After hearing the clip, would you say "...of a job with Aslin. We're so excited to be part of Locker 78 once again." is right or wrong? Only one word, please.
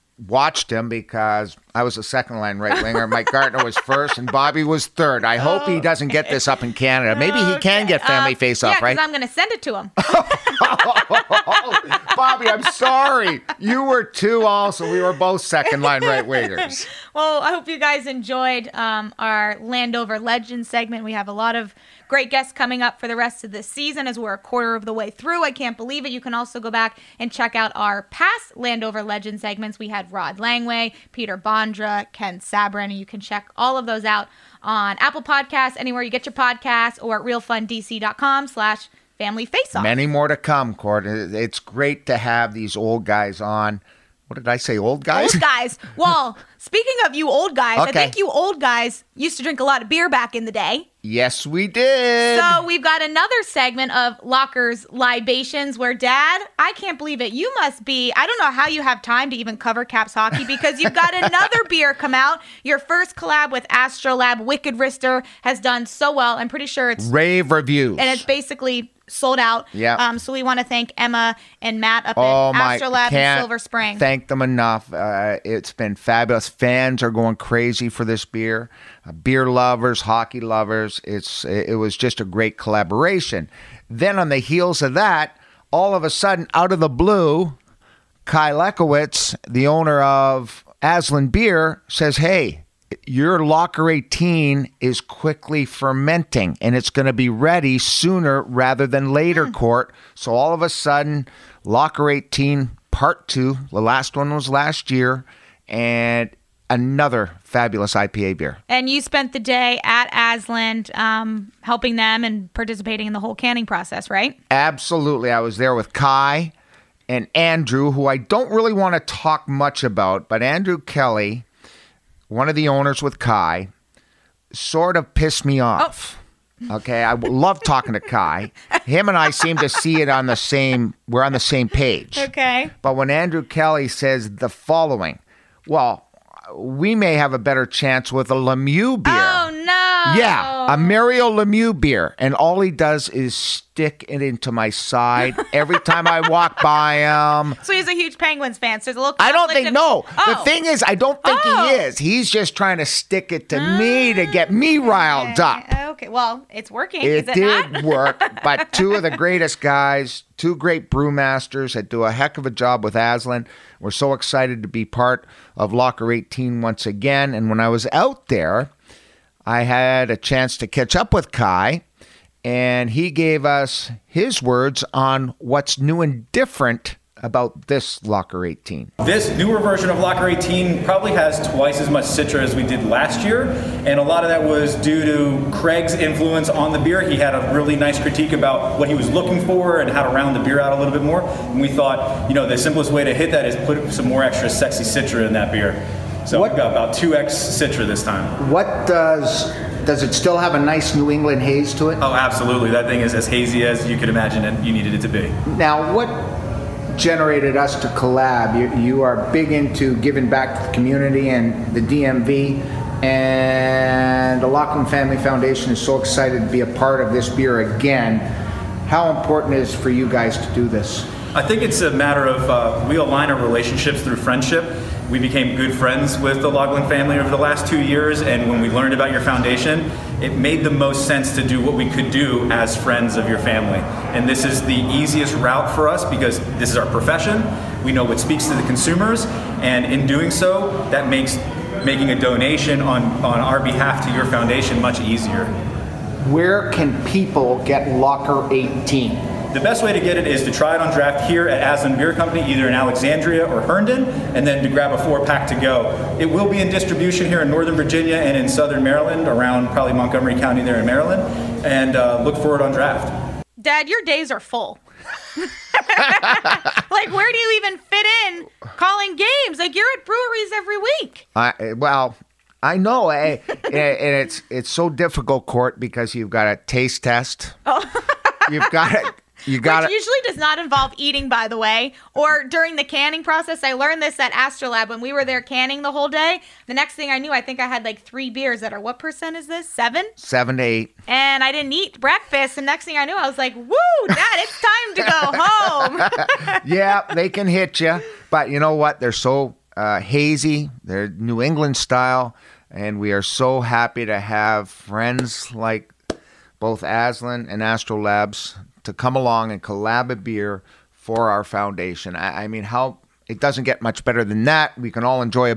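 wrong.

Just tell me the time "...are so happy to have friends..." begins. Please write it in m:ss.
5:03.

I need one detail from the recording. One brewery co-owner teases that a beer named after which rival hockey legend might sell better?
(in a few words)
Mario Lemieux.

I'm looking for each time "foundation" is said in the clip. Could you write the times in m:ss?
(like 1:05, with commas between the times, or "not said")
3:35, 3:49, 4:04, 5:11.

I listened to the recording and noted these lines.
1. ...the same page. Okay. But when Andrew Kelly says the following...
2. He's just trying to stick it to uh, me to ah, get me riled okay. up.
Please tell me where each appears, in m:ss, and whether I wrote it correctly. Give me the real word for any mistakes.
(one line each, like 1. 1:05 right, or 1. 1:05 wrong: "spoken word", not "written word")
1. 2:11 right
2. 2:31 right.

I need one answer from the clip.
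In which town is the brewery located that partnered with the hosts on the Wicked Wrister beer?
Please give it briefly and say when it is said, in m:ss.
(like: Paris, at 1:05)
Silver Spring, at 1:13.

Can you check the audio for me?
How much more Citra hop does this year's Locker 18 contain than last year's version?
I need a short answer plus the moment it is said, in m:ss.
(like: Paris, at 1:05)
2x, at 3:16.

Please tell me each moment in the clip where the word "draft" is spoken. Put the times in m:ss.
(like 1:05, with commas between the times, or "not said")
4:10, 4:22.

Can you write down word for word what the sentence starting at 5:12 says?
I, I mean, how it doesn't get much better than that.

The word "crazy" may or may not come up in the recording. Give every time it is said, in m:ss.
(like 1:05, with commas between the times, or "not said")
1:17.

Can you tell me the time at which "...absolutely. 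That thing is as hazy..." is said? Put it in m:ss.
3:22.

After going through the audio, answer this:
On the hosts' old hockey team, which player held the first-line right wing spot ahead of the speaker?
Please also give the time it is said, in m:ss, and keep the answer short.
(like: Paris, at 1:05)
Mike Gartner, at 0:03.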